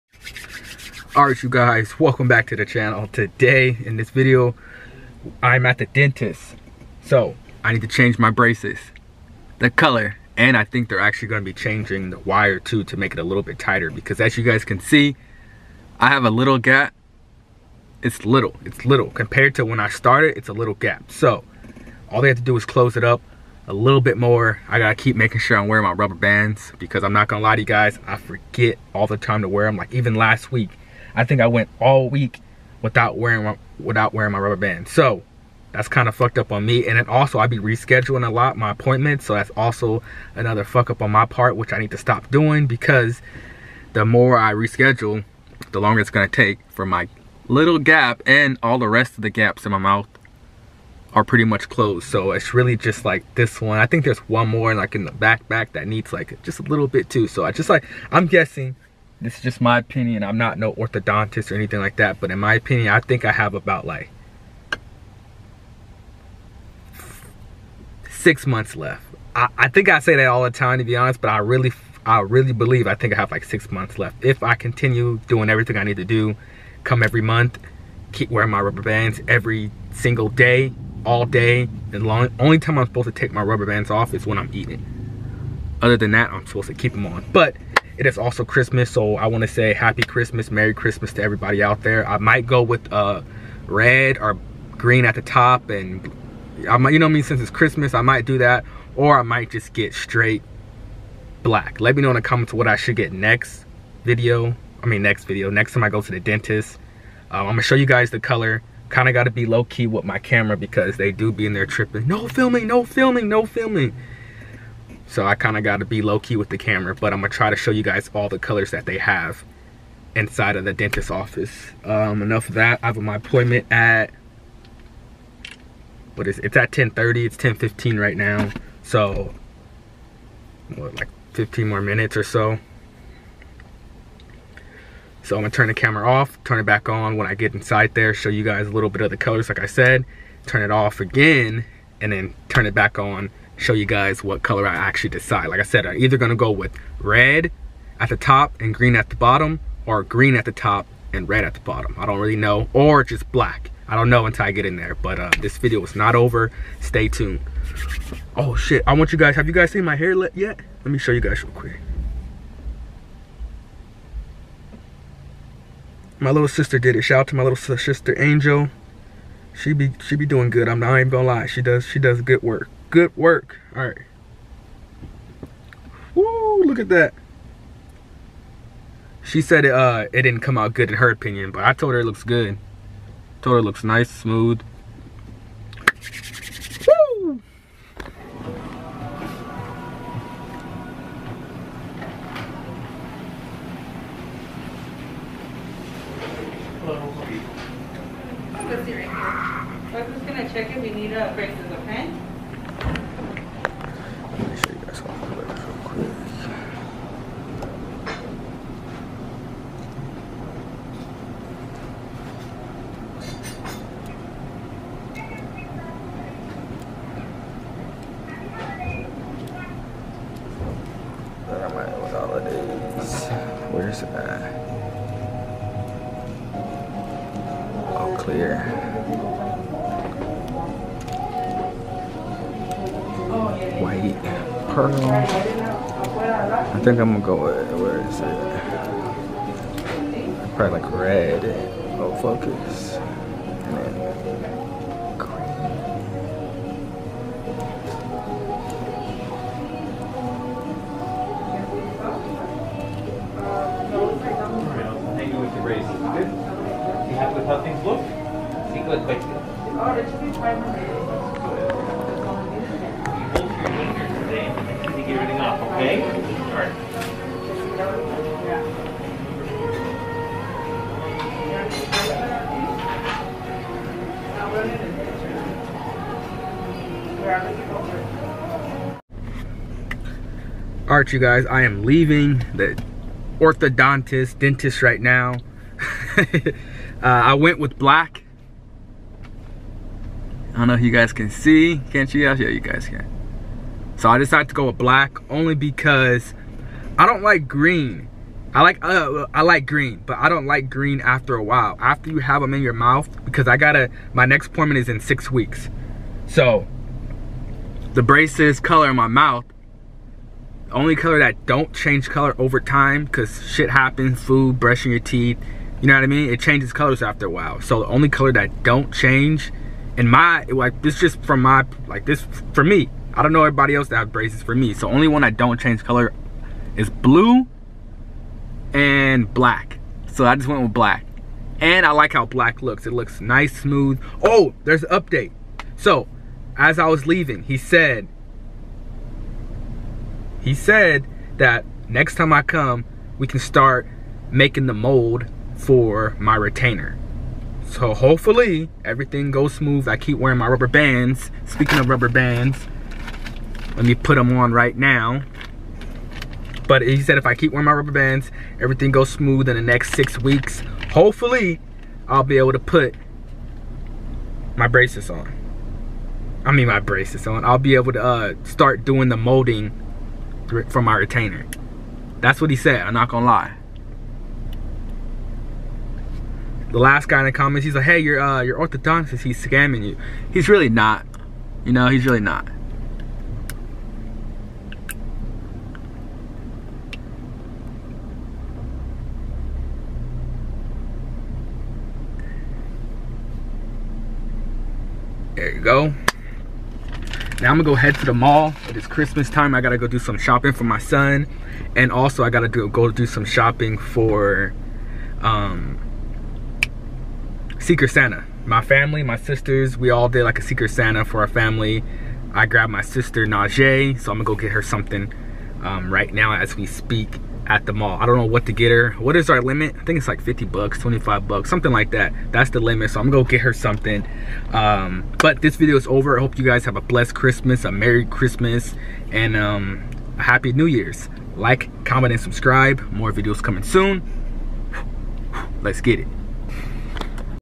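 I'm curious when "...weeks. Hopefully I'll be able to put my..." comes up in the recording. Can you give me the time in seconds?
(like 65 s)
360 s.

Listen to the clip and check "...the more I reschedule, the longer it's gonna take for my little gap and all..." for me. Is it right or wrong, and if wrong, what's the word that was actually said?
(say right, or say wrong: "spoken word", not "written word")
right.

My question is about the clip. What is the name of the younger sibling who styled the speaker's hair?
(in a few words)
Angel.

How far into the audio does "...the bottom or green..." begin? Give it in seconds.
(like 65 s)
149 s.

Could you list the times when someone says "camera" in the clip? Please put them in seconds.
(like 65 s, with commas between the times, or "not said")
110 s, 116 s, 135 s.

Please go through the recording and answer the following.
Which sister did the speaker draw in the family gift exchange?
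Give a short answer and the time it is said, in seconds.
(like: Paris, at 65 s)
Najee, at 413 s.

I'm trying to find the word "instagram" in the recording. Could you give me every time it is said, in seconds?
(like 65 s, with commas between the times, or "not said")
not said.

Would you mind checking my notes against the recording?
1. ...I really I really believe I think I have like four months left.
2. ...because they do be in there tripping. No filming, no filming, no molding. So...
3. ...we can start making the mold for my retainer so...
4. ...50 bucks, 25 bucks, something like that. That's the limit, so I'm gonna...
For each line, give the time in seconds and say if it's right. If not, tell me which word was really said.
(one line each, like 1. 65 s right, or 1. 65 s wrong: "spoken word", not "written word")
1. 71 s wrong: "six", not "four"
2. 110 s wrong: "filming", not "molding"
3. 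343 s right
4. 420 s right.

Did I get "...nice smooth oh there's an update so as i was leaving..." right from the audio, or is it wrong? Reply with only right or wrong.
right.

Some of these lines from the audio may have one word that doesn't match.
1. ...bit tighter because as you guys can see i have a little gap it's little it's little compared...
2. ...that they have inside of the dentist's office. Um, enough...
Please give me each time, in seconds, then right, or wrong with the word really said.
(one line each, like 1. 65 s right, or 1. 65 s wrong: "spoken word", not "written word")
1. 13 s right
2. 118 s right.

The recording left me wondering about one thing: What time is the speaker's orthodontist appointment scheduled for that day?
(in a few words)
10:30.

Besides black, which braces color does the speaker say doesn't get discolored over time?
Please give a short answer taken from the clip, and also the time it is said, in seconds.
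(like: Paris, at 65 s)
Blue, at 326 s.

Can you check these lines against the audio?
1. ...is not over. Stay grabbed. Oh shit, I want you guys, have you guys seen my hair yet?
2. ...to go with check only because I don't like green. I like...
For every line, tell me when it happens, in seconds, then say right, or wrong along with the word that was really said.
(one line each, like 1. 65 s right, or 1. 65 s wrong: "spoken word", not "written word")
1. 155 s wrong: "tuned", not "grabbed"
2. 294 s wrong: "black", not "check".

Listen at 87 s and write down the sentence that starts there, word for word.
But it is also Christmas, so I want to say Happy Christmas, Merry Christmas to everybody out there.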